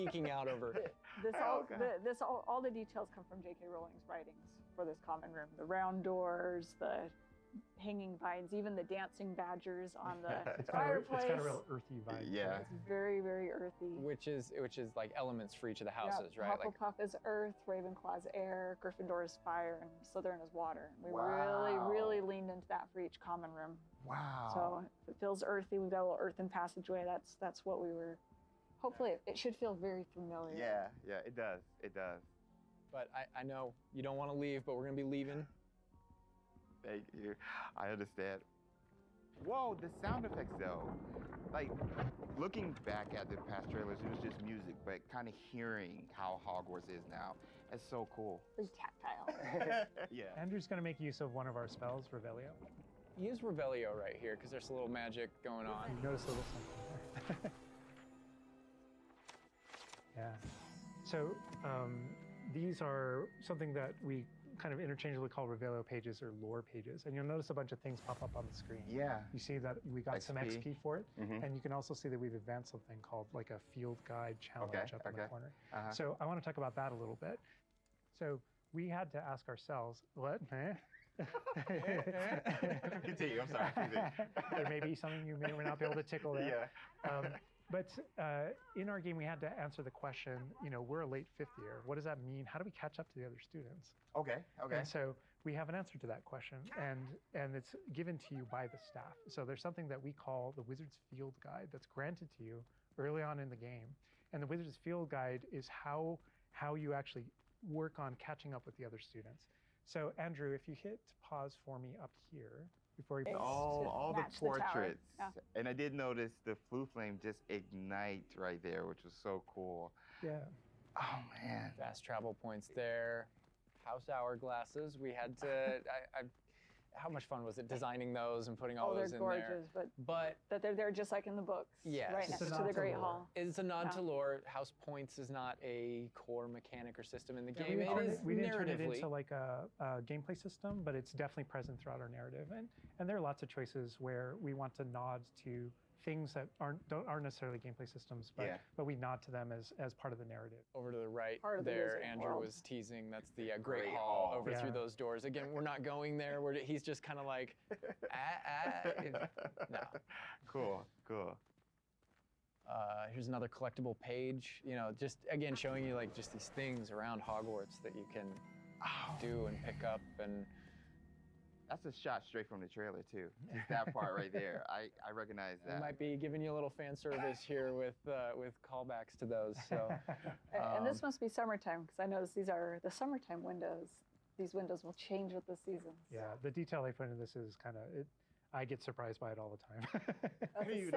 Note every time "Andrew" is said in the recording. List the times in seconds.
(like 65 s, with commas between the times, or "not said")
50 s, 110 s, 152 s.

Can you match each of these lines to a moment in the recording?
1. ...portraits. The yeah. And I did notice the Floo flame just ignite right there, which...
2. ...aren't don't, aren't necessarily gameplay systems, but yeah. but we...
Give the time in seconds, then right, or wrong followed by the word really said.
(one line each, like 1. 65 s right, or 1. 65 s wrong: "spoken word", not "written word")
1. 114 s right
2. 146 s right.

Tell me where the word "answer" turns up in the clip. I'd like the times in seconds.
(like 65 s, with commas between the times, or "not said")
89 s, 95 s.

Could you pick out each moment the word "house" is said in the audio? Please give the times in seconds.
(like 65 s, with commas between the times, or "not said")
15 s, 123 s, 134 s.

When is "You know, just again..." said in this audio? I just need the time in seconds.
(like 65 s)
164 s.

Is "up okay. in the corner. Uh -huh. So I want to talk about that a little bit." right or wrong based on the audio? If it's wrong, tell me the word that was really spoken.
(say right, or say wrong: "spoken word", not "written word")
right.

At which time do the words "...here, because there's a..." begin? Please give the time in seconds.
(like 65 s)
54 s.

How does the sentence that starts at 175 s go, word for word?
I might be giving you a little fan service here with uh, with callbacks to those.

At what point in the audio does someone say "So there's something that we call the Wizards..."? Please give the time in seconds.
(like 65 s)
99 s.